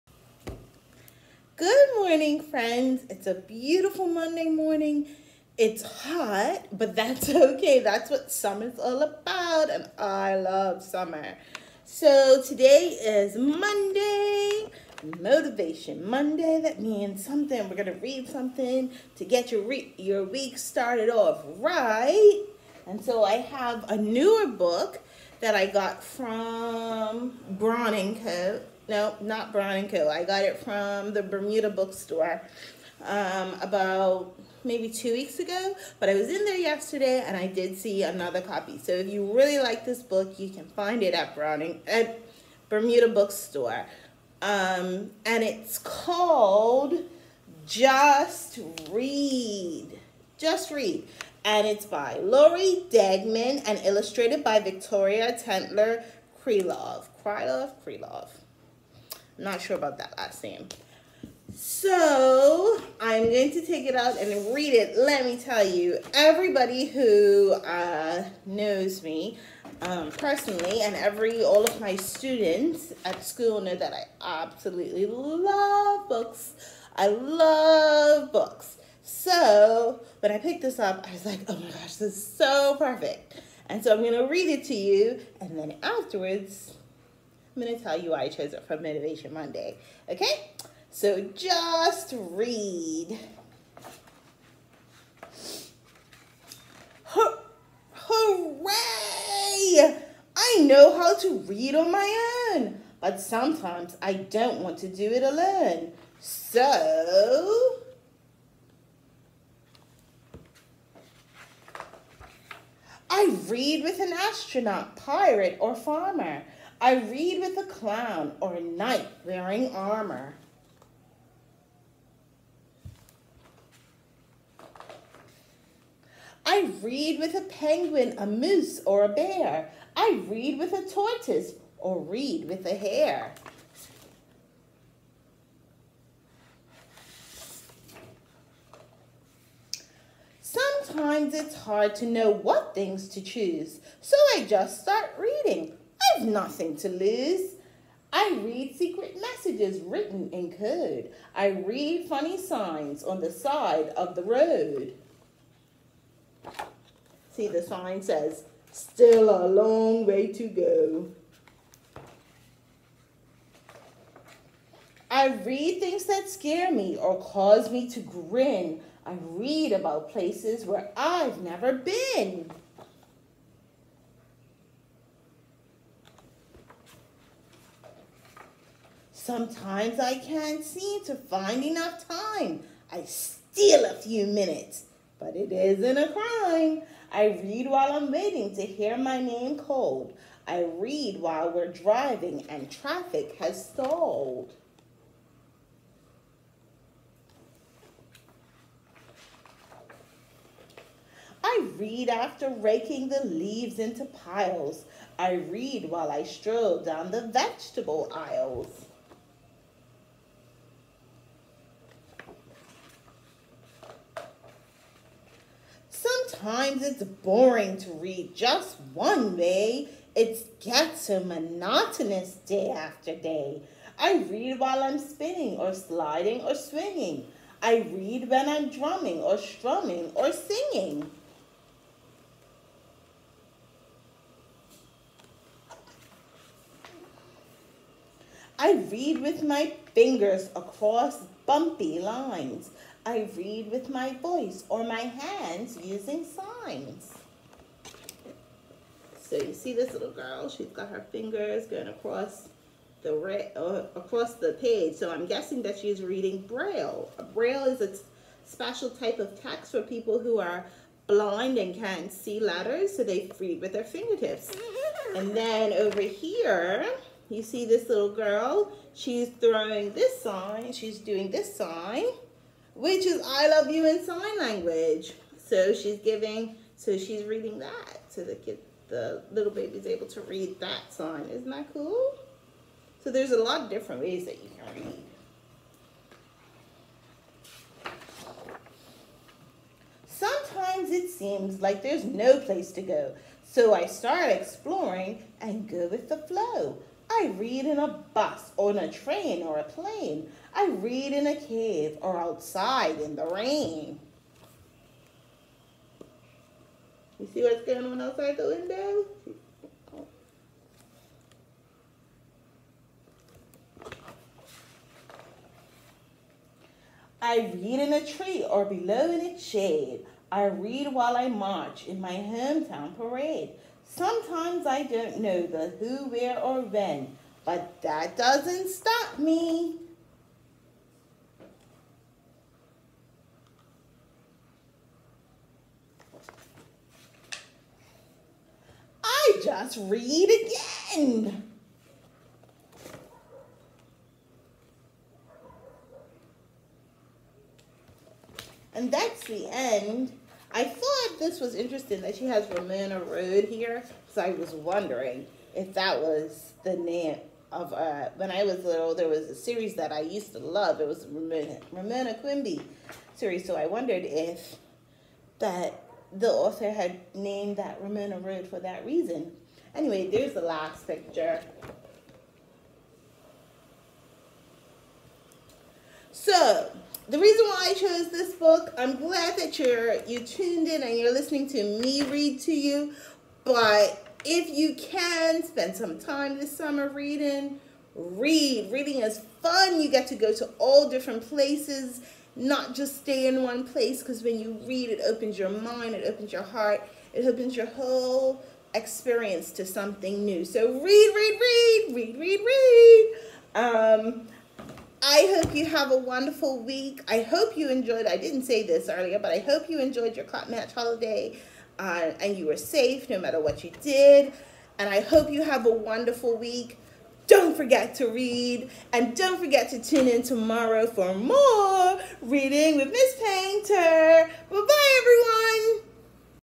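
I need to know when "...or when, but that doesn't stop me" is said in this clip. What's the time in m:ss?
5:26.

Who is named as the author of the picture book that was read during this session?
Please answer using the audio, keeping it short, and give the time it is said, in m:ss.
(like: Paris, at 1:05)
Lori Degman, at 0:52.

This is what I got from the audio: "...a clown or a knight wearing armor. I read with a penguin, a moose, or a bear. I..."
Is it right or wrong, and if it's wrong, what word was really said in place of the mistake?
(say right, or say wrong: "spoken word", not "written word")
right.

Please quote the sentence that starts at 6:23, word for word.
But if you can spend some time this summer reading, read.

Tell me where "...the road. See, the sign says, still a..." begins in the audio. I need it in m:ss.
2:34.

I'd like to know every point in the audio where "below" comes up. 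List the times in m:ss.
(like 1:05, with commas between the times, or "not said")
5:18.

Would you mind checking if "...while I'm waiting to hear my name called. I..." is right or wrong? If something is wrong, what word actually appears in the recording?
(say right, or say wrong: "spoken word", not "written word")
right.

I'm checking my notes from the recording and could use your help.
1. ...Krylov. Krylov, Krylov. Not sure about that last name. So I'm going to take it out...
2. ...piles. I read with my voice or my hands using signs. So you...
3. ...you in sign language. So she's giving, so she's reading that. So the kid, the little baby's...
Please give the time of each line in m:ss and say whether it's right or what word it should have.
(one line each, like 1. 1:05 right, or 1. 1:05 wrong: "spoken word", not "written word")
1. 0:56 right
2. 4:01 wrong: "lines", not "piles"
3. 4:33 right.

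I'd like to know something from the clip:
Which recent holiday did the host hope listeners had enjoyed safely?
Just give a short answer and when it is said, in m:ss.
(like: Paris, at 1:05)
Cup Match, at 6:50.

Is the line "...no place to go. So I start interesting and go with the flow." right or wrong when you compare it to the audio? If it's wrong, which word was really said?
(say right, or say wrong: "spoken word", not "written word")
wrong: "exploring", not "interesting".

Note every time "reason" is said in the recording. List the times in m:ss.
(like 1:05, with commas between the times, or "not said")
6:08, 6:17.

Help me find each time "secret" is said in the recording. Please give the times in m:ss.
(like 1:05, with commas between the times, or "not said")
2:28.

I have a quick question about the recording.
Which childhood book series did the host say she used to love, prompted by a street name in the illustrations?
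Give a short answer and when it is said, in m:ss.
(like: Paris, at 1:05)
Ramona Quimby, at 6:01.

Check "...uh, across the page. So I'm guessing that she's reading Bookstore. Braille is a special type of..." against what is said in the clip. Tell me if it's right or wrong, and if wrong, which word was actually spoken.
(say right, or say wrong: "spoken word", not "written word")
wrong: "Braille", not "Bookstore".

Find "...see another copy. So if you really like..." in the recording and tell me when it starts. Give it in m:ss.
0:37.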